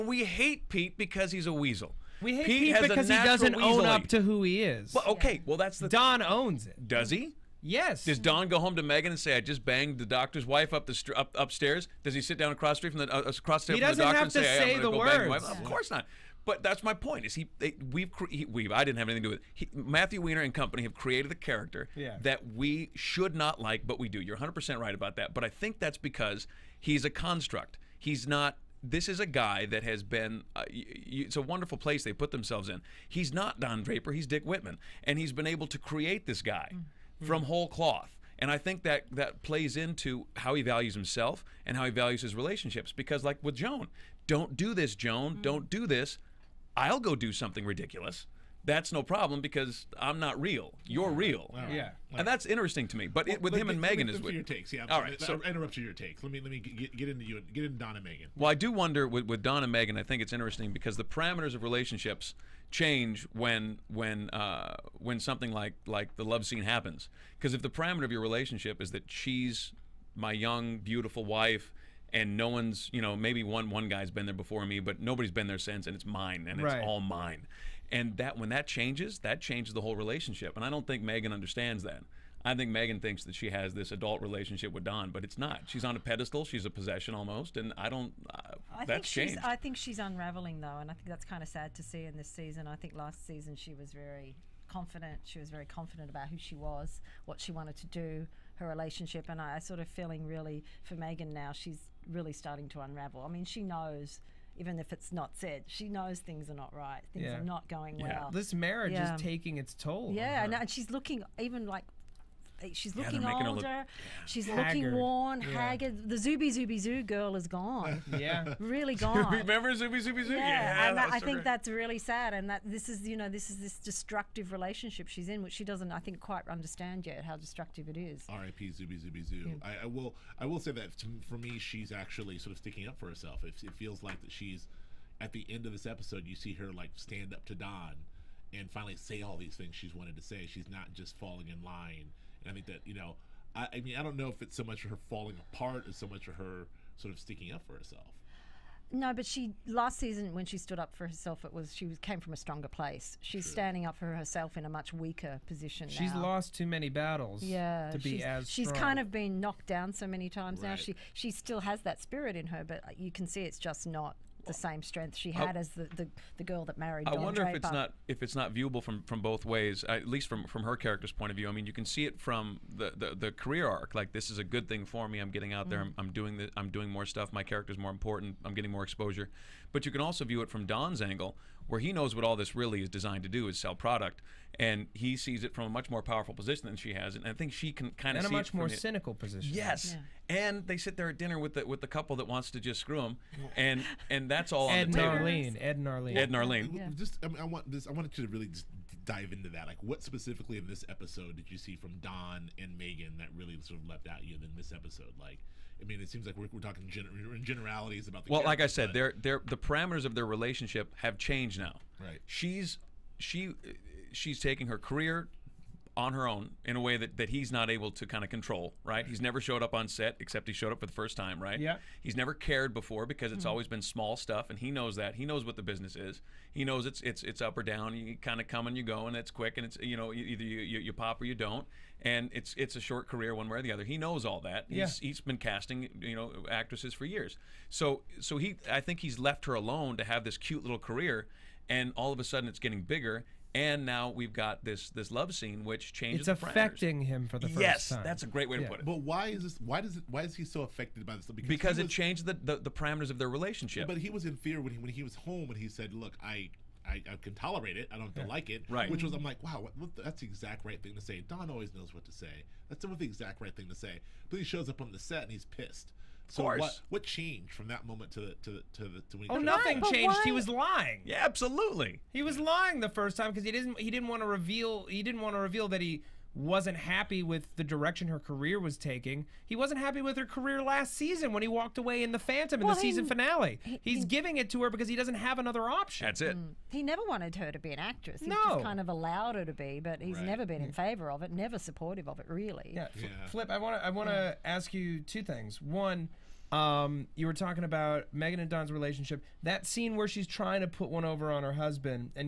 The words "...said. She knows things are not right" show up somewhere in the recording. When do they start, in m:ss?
1:45.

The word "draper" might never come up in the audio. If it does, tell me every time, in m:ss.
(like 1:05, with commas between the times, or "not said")
0:33, 2:47.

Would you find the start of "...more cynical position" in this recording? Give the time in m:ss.
3:08.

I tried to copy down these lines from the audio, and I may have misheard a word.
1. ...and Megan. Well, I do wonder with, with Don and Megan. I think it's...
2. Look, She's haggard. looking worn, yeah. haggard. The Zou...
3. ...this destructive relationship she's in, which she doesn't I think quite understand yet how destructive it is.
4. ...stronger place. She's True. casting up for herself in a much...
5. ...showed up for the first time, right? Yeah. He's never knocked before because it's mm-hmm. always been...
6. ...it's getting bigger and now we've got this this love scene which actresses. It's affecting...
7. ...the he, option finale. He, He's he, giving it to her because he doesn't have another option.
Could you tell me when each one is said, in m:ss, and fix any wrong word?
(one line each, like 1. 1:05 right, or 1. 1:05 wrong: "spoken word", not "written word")
1. 0:57 right
2. 1:53 right
3. 2:03 right
4. 2:32 wrong: "standing", not "casting"
5. 3:40 wrong: "cared", not "knocked"
6. 4:02 wrong: "changes", not "actresses"
7. 4:42 wrong: "season", not "option".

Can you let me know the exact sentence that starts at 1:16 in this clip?
it's all mine and that when that changes, that changes the whole relationship.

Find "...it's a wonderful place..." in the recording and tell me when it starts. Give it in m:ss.
0:30.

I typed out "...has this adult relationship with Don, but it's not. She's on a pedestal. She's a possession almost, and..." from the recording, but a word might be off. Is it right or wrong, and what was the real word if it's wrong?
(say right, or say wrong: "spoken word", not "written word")
right.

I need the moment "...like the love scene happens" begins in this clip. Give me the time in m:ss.
1:05.